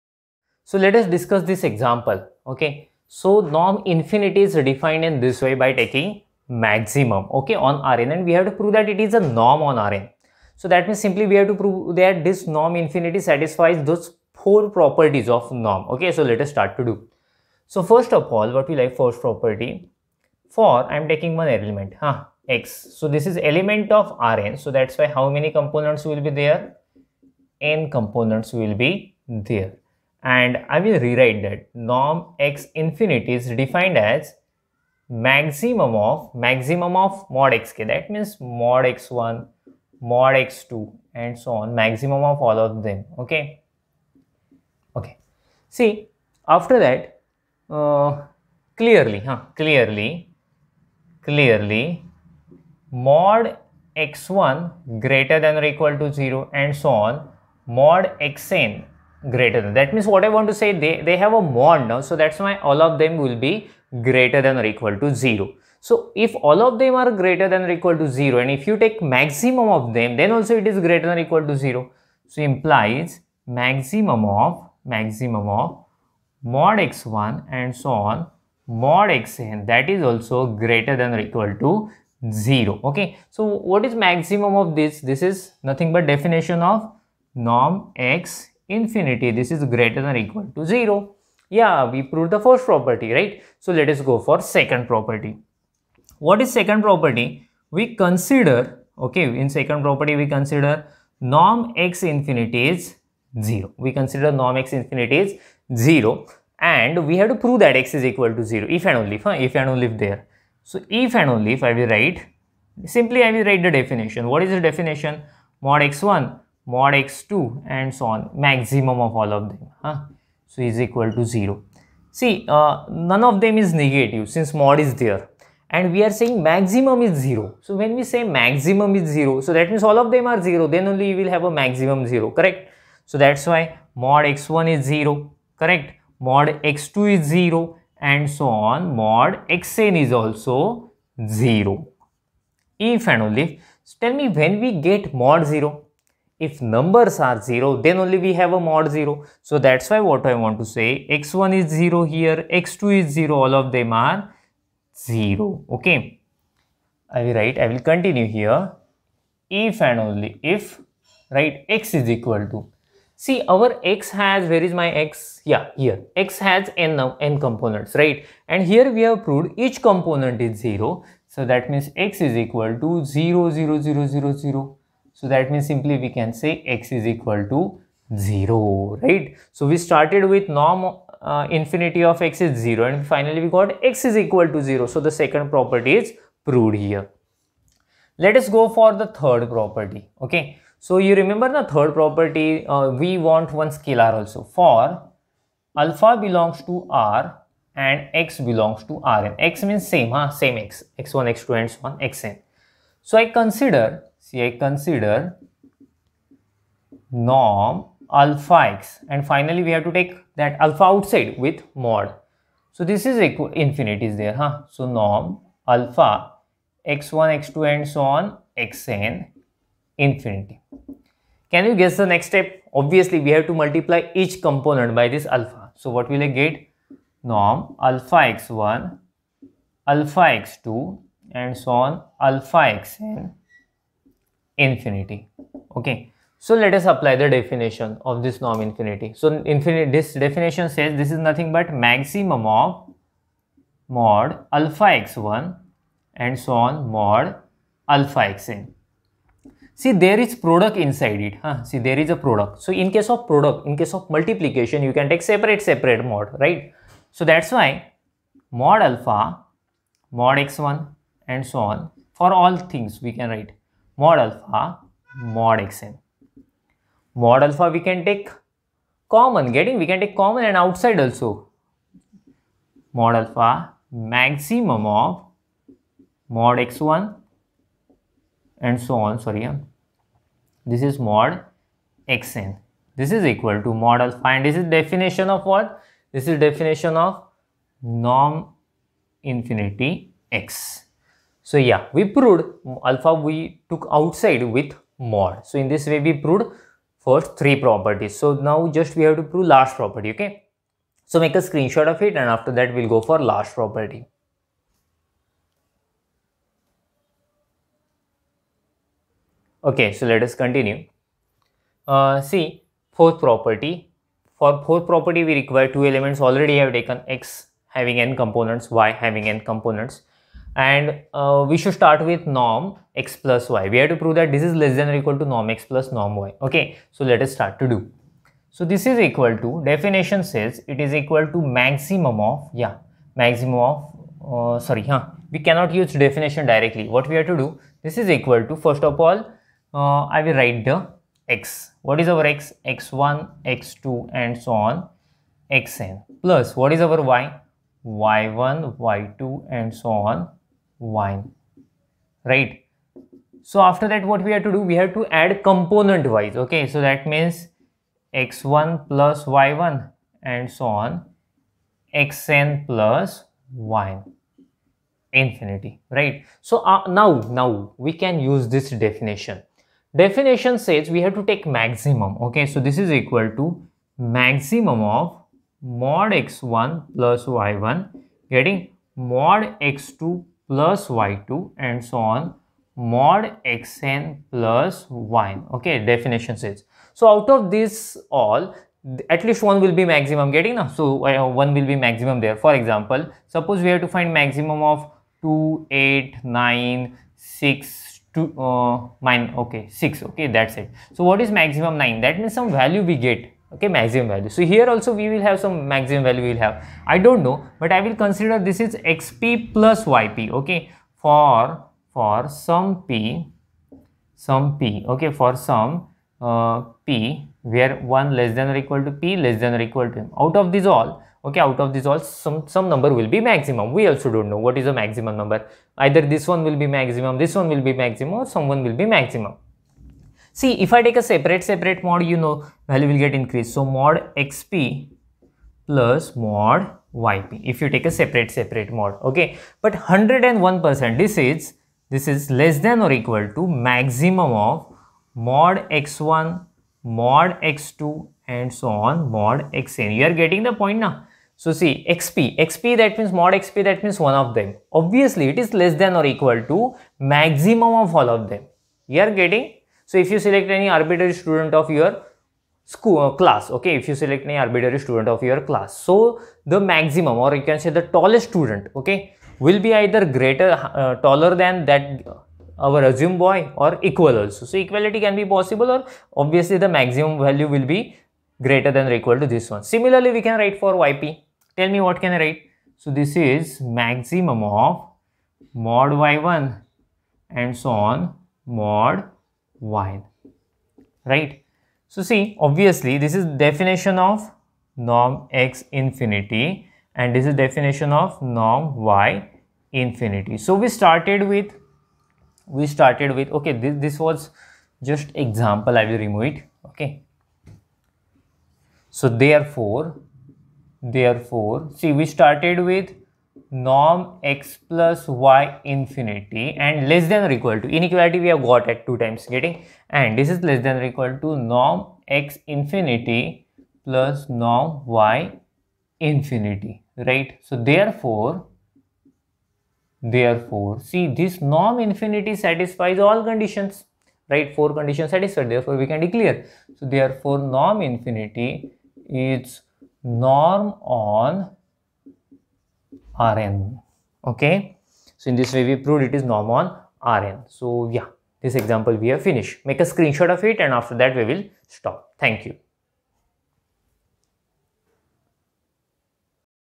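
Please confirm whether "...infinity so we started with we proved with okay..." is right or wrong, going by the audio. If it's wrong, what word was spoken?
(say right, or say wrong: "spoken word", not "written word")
wrong: "started", not "proved".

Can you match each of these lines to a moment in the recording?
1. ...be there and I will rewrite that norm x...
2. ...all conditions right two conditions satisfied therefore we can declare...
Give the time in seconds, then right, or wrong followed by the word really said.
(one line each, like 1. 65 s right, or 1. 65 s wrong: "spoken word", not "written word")
1. 28 s right
2. 532 s wrong: "four", not "two".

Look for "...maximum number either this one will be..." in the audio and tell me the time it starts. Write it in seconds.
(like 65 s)
424 s.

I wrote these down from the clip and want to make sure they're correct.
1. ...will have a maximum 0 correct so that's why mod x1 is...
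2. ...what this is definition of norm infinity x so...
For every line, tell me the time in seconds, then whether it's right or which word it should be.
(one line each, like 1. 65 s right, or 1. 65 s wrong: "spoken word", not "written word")
1. 131 s right
2. 285 s right.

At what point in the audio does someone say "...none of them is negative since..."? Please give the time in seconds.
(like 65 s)
122 s.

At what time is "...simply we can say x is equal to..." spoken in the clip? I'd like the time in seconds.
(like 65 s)
175 s.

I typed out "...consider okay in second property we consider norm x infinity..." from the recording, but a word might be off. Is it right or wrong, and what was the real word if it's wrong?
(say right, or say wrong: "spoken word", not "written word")
right.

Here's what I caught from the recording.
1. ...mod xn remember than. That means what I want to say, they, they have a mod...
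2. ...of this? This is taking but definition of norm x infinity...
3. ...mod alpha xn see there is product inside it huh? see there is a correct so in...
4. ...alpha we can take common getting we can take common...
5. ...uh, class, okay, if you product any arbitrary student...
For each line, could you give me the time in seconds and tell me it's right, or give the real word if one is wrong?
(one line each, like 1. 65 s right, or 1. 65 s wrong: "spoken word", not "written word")
1. 57 s wrong: "greater", not "remember"
2. 84 s wrong: "nothing", not "taking"
3. 246 s wrong: "product", not "correct"
4. 267 s right
5. 462 s wrong: "select", not "product".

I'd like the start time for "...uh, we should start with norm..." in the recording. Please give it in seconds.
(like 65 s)
321 s.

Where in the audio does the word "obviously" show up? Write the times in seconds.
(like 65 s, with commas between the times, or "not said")
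222 s, 454 s, 476 s, 492 s.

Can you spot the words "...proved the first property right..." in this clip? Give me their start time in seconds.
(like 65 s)
92 s.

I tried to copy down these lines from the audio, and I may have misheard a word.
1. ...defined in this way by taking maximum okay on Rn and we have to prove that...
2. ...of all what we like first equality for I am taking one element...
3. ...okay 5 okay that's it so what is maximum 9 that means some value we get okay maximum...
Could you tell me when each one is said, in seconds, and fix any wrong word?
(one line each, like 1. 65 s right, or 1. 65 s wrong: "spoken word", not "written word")
1. 4 s right
2. 18 s wrong: "property", not "equality"
3. 399 s wrong: "6", not "5".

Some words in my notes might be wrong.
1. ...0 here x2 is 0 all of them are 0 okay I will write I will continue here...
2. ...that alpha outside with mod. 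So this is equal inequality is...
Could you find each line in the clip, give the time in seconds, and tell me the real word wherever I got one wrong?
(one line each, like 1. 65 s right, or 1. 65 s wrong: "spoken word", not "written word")
1. 151 s right
2. 210 s wrong: "infinity", not "inequality".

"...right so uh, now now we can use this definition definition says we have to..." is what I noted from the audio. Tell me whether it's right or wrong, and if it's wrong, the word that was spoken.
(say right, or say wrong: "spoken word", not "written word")
right.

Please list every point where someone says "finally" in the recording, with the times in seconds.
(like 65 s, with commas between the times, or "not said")
183 s, 209 s.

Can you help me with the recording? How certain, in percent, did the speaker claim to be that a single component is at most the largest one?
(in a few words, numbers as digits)
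101%.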